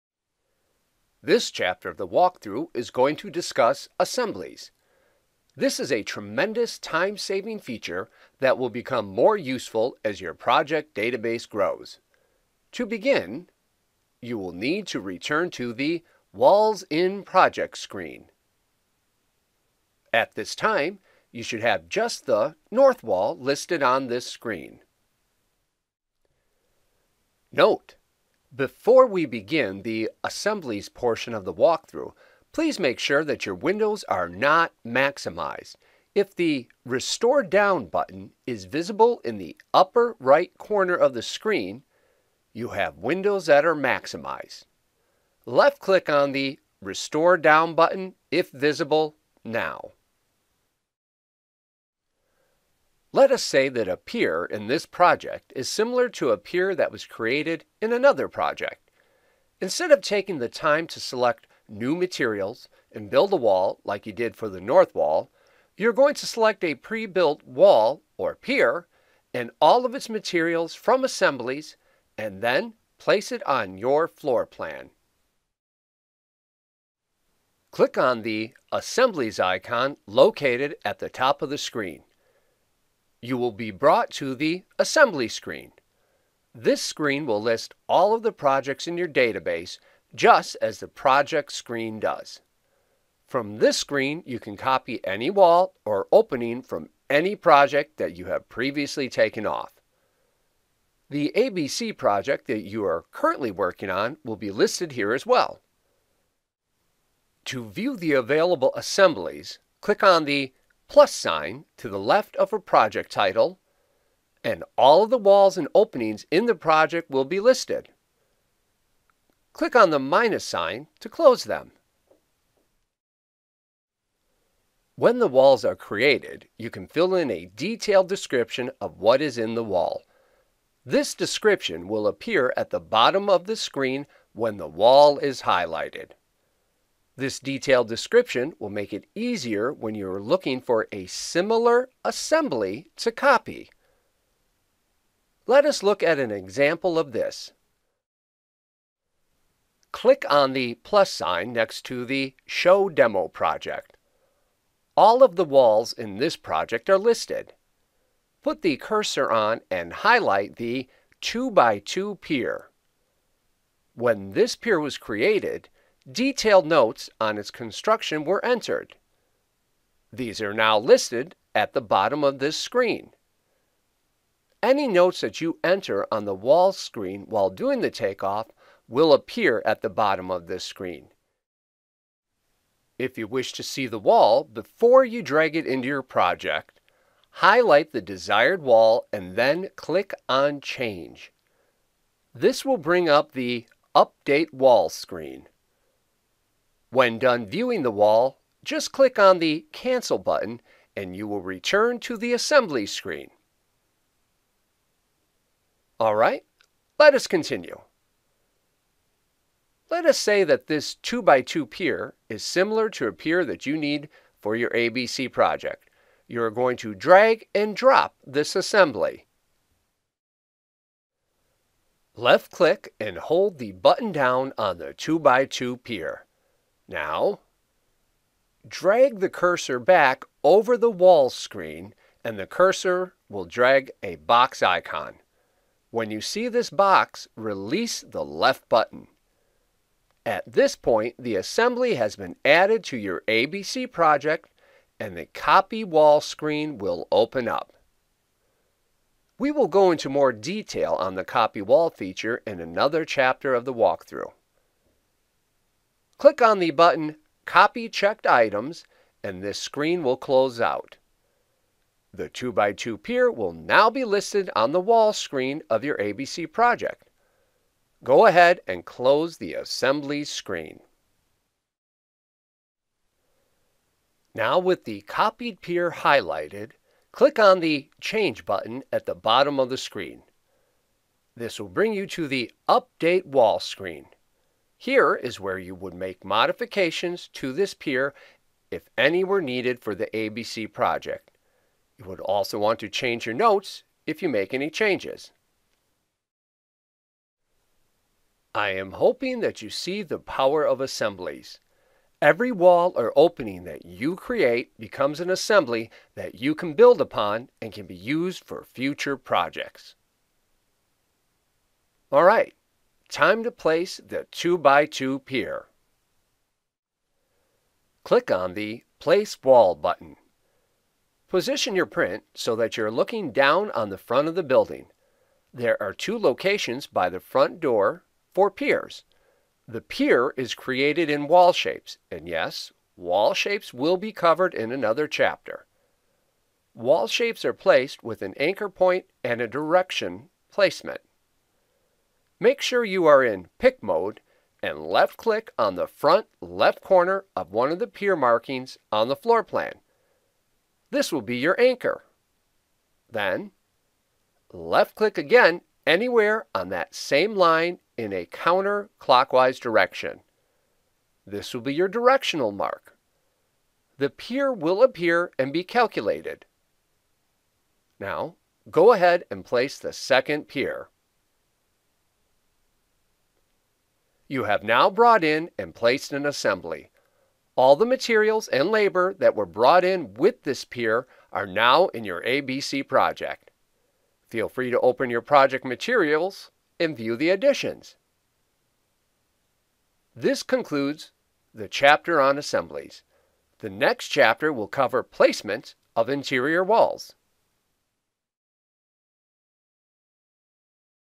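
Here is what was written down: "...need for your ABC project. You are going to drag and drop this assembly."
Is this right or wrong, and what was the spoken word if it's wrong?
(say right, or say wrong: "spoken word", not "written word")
right.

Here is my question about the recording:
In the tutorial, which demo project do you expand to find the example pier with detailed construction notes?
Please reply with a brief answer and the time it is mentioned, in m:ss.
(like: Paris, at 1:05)
Show Demo, at 2:32.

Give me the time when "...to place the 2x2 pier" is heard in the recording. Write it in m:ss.
5:13.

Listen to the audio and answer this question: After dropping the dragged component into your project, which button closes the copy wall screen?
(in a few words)
Copy Checked Items.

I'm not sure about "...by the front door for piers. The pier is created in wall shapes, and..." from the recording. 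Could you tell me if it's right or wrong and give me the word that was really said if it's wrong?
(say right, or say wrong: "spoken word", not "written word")
right.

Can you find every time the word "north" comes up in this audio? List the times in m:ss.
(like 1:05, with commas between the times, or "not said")
0:22, 1:04.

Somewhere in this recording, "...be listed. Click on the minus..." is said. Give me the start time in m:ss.
1:57.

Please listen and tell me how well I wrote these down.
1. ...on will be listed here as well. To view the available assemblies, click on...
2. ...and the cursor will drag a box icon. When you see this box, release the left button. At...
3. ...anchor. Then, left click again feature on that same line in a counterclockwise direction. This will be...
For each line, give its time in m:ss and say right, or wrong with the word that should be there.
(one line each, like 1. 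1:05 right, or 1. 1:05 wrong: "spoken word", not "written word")
1. 1:43 right
2. 3:52 right
3. 5:51 wrong: "anywhere", not "feature".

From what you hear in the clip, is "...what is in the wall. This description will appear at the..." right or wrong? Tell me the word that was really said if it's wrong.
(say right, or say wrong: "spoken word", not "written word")
right.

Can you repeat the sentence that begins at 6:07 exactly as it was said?
Now, go ahead and place the second pier.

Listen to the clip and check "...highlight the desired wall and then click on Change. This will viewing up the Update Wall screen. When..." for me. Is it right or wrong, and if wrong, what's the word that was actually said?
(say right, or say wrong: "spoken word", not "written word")
wrong: "bring", not "viewing".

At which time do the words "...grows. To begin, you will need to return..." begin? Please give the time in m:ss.
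0:11.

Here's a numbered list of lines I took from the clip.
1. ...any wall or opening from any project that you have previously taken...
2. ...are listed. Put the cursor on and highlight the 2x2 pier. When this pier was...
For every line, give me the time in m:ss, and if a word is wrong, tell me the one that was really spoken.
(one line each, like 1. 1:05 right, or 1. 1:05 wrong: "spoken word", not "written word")
1. 1:35 right
2. 2:36 right.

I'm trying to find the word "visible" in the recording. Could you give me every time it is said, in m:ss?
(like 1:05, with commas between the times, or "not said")
0:38, 0:48.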